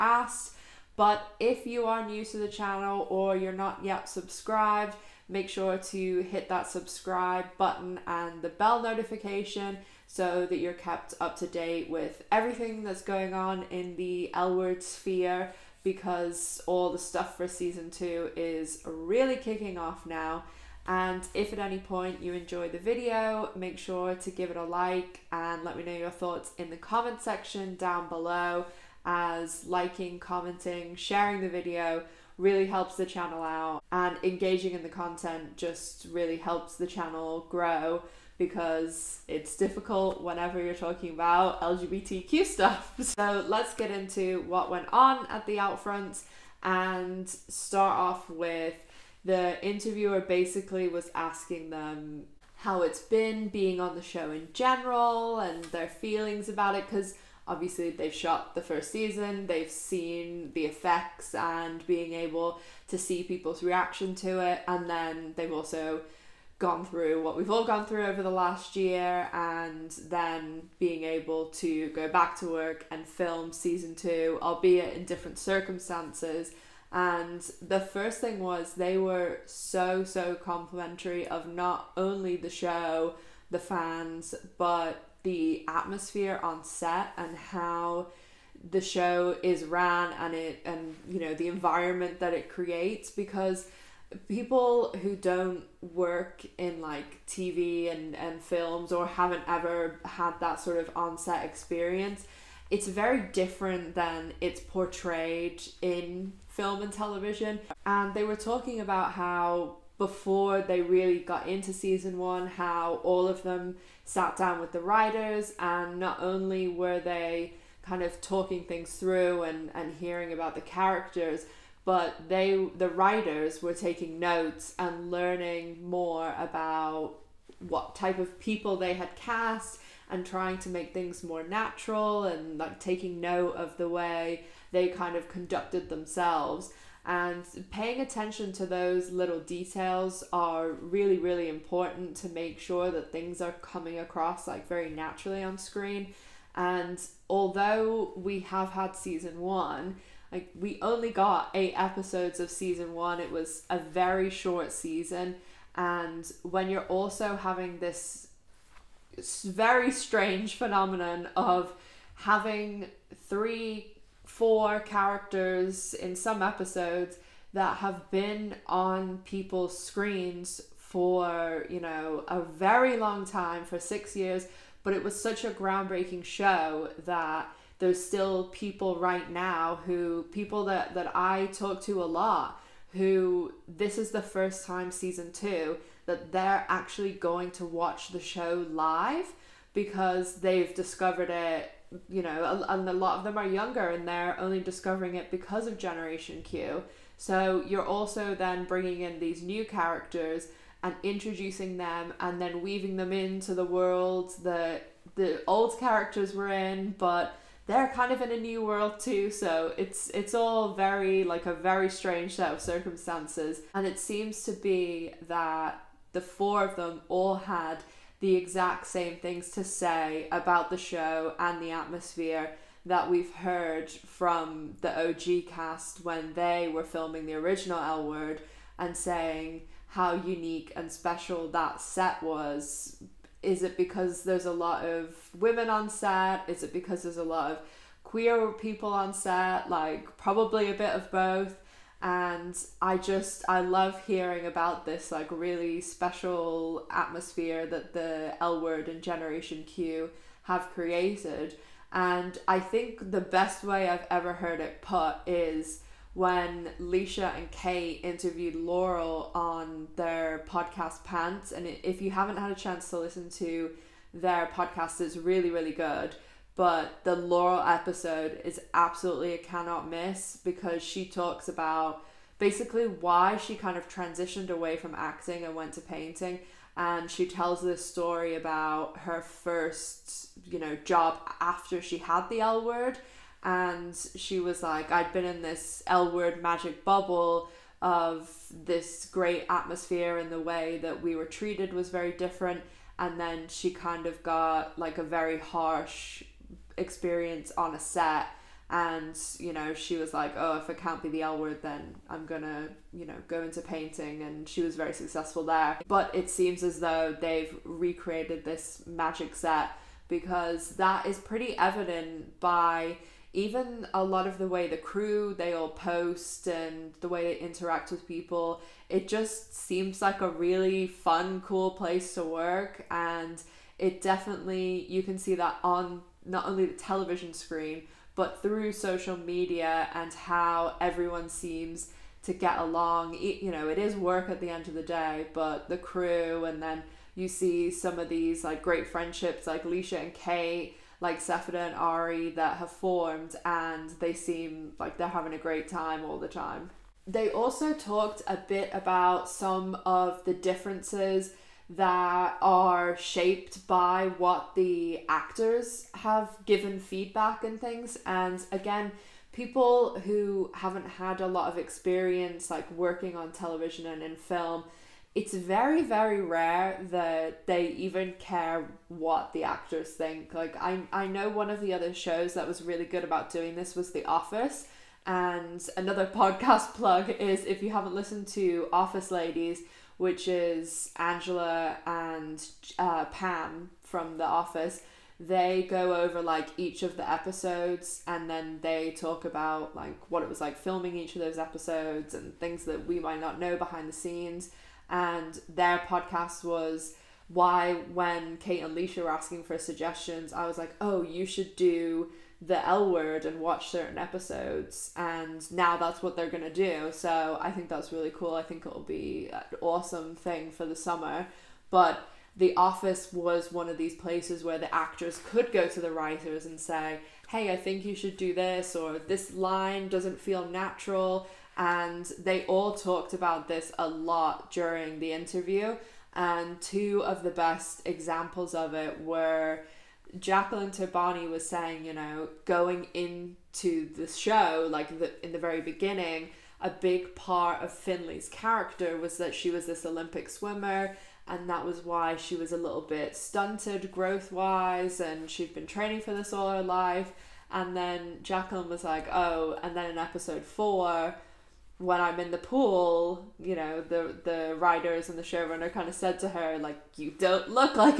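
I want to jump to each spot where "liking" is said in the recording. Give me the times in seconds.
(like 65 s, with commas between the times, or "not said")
29 s.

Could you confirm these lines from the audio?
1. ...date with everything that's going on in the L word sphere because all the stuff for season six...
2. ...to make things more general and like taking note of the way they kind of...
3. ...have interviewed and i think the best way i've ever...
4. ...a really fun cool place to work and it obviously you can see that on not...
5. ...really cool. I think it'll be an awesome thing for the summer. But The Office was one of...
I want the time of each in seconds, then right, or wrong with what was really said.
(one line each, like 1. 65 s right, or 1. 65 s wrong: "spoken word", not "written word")
1. 11 s wrong: "two", not "six"
2. 130 s wrong: "natural", not "general"
3. 250 s wrong: "created", not "interviewed"
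4. 320 s wrong: "definitely", not "obviously"
5. 407 s right.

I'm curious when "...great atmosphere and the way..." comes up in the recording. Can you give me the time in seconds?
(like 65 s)
289 s.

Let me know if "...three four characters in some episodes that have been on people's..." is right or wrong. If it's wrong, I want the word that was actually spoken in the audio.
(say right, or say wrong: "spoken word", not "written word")
right.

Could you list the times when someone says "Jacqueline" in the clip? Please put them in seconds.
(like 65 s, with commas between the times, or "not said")
430 s, 448 s.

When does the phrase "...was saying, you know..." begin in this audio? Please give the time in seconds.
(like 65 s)
431 s.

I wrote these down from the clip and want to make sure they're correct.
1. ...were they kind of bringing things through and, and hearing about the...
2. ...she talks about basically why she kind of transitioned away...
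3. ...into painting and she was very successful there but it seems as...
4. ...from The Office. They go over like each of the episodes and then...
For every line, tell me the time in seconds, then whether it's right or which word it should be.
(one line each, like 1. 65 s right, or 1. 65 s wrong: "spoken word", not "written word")
1. 116 s wrong: "talking", not "bringing"
2. 270 s right
3. 303 s right
4. 383 s right.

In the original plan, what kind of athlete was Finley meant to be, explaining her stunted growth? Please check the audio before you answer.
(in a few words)
Olympic swimmer.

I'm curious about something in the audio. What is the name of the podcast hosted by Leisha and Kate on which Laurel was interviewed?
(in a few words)
Pants.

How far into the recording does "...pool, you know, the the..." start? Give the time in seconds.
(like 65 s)
452 s.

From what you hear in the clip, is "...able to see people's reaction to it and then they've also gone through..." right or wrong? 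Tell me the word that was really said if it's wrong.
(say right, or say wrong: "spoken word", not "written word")
right.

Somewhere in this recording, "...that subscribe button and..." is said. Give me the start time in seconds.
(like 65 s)
6 s.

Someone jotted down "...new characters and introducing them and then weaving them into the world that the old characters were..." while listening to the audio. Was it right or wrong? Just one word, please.
right.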